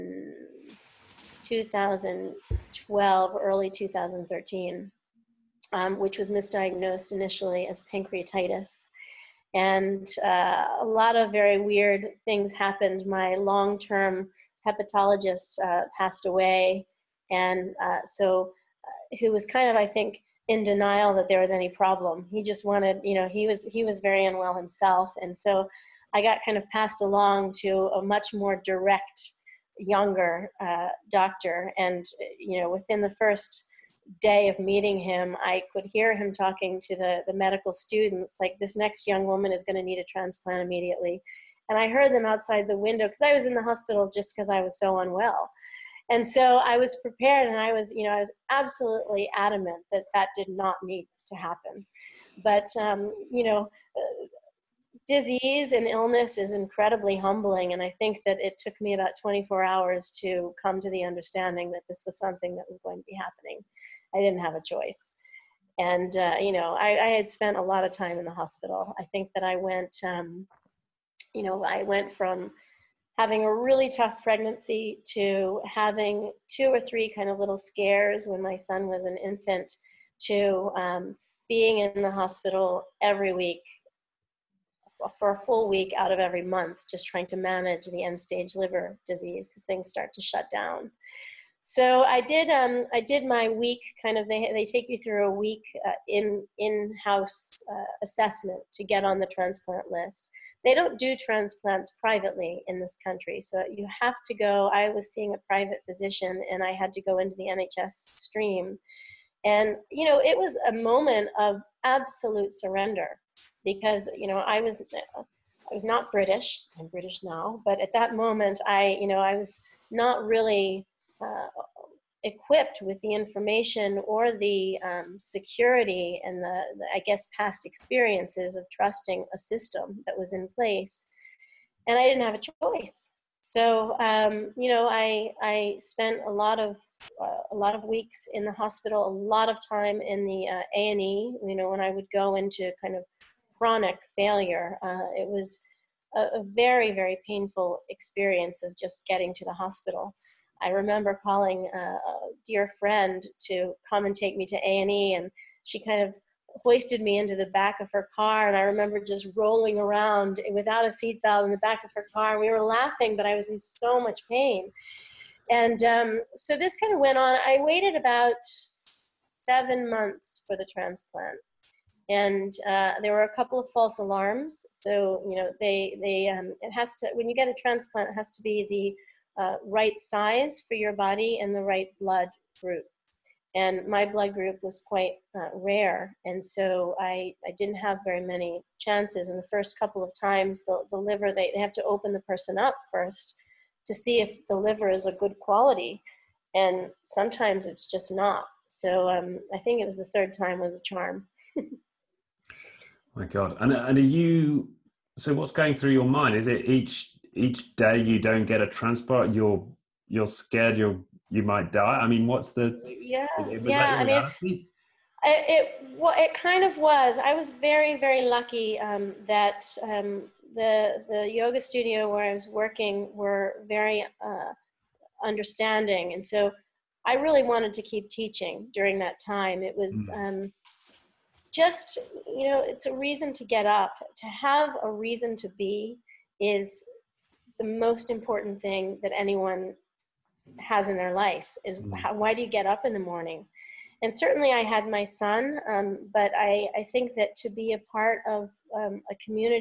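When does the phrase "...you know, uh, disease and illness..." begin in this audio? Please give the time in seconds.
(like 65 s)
53 s.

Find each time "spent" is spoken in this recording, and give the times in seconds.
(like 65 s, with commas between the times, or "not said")
67 s, 135 s.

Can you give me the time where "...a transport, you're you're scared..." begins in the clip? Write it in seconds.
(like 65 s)
208 s.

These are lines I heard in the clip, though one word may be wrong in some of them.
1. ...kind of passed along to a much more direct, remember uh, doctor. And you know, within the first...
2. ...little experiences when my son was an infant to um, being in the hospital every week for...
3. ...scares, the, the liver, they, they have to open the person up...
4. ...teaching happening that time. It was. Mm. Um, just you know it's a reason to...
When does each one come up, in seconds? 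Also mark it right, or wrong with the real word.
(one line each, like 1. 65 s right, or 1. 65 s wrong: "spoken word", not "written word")
1. 26 s wrong: "younger", not "remember"
2. 77 s wrong: "scares", not "experiences"
3. 190 s wrong: "times", not "scares"
4. 228 s wrong: "during", not "happening".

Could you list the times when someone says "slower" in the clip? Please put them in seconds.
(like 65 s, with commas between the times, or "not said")
not said.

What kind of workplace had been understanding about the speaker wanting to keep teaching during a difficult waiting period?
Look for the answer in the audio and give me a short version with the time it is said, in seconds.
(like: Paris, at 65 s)
yoga studio, at 221 s.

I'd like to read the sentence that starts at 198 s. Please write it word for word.
So um, I think it was the third time was a charm.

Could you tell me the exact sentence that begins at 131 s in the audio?
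And I didn't have a choice.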